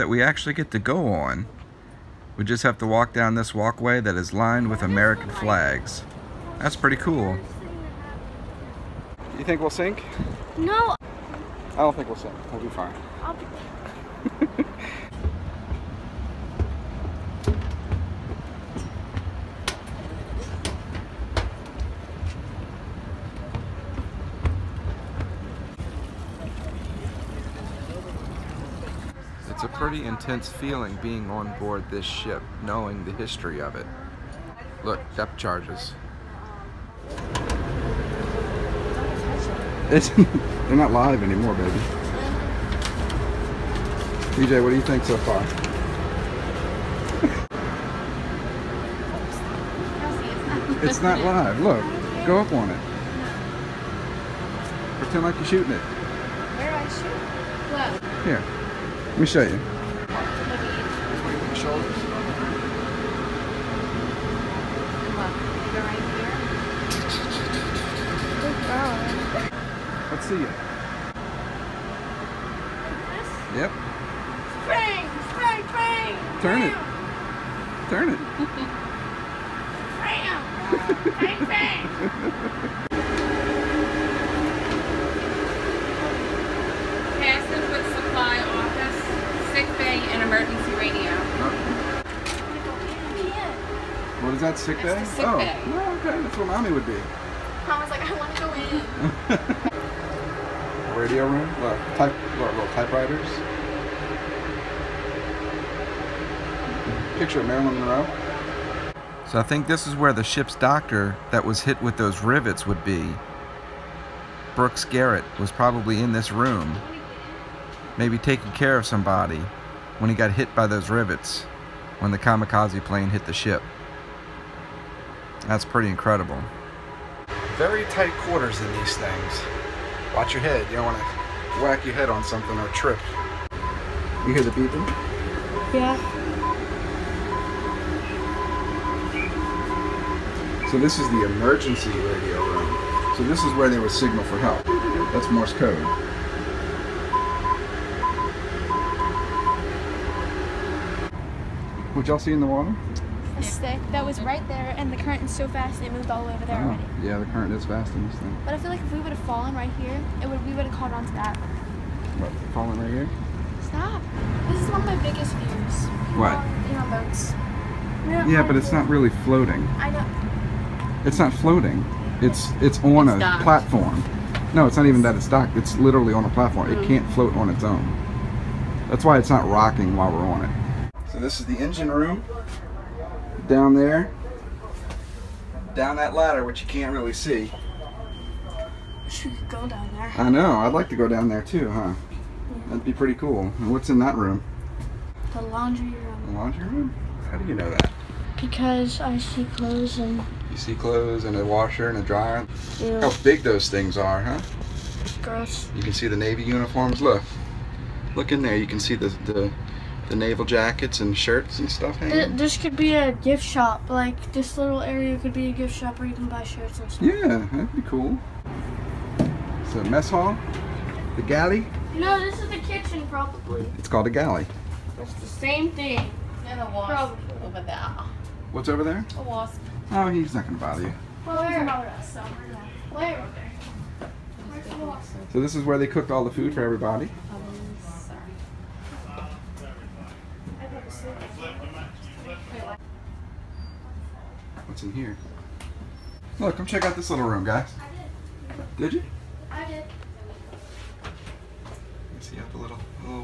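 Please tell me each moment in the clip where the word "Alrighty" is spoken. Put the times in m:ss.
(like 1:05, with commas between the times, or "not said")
not said.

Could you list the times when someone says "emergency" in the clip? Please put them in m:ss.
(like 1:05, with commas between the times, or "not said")
1:30, 2:21.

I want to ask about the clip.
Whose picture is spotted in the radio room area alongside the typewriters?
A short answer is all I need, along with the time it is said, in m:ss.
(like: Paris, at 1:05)
Marilyn Monroe, at 1:47.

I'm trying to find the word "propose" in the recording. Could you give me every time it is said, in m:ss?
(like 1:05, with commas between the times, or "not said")
not said.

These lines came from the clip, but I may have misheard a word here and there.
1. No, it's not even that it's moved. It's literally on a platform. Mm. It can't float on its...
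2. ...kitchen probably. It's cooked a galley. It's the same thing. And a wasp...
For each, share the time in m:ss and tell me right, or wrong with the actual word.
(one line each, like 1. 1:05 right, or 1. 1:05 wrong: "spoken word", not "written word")
1. 2:54 wrong: "docked", not "moved"
2. 3:42 wrong: "called", not "cooked".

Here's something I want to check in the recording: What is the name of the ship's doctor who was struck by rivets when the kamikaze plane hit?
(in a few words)
Brooks Garrett.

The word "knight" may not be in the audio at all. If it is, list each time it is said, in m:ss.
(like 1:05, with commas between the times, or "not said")
not said.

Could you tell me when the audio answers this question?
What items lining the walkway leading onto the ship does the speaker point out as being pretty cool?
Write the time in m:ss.
0:04.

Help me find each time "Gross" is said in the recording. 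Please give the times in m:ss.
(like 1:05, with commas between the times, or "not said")
3:25.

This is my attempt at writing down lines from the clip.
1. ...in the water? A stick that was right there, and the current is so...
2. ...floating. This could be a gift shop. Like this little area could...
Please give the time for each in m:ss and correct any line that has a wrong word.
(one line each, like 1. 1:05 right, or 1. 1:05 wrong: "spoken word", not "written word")
1. 2:32 right
2. 3:31 wrong: "hanging", not "floating".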